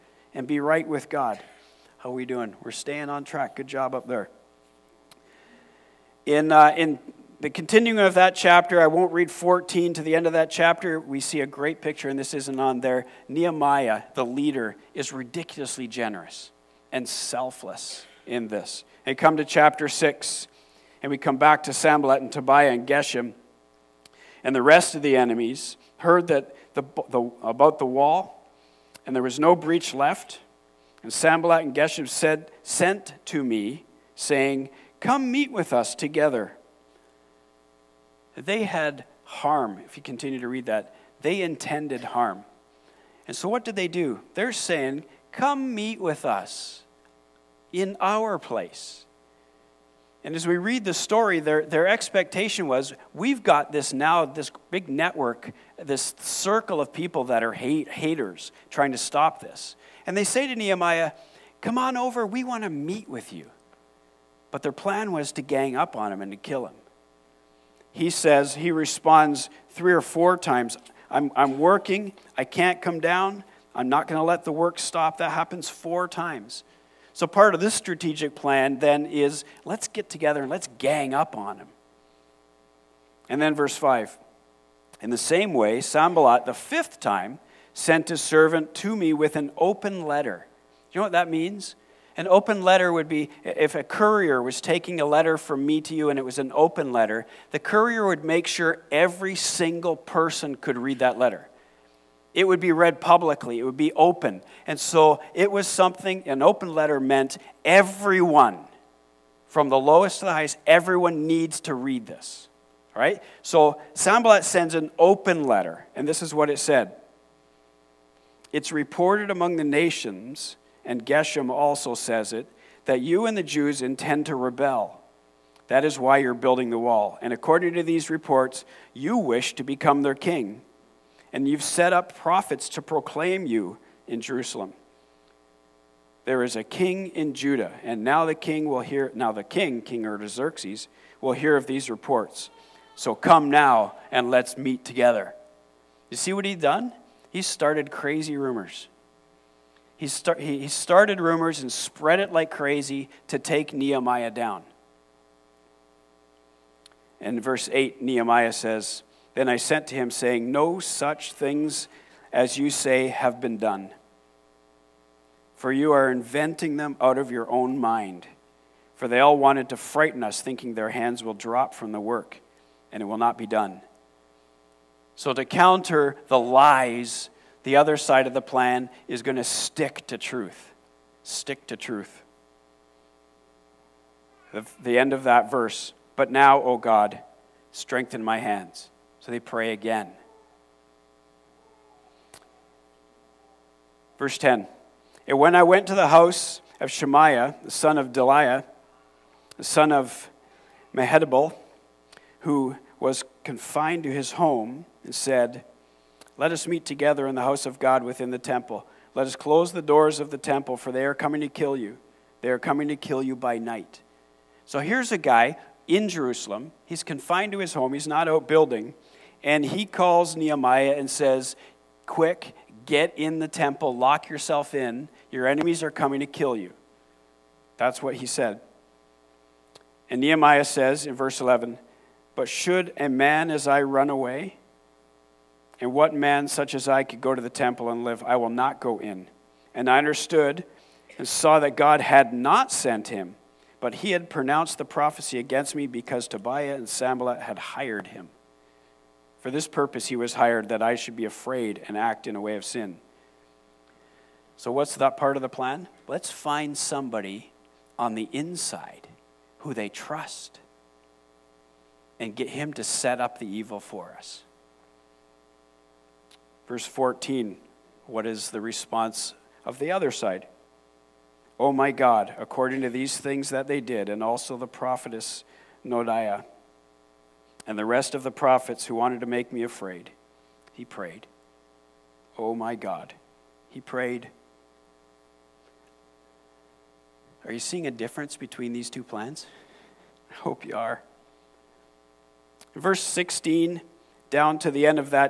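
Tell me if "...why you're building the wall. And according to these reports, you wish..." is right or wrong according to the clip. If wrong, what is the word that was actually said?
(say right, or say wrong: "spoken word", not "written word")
right.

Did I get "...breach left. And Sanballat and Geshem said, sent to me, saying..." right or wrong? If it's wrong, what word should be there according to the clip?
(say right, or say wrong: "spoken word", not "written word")
right.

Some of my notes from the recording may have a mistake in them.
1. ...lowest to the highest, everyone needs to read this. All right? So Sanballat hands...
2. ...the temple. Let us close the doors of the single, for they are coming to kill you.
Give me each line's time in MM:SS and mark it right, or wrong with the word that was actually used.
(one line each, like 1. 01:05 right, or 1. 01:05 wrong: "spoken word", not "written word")
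1. 01:49 wrong: "sends", not "hands"
2. 03:28 wrong: "temple", not "single".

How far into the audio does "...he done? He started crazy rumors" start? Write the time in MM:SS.
02:26.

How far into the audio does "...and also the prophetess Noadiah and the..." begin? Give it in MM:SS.
04:34.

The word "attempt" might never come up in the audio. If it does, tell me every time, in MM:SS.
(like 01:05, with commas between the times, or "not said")
not said.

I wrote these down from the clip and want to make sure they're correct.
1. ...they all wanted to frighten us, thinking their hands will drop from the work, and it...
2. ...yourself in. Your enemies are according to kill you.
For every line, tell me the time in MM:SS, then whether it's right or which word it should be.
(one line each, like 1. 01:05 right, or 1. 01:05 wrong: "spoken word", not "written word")
1. 02:49 right
2. 03:44 wrong: "coming", not "according".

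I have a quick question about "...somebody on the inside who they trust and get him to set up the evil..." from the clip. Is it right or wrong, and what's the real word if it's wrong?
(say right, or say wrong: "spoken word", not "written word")
right.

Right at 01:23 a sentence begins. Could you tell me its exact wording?
And then, verse 5 In the same way, Sanballat, the fifth time, sent his servant to me with an open letter.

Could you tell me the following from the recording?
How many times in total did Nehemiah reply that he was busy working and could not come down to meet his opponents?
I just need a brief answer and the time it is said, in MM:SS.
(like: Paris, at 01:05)
4, at 01:15.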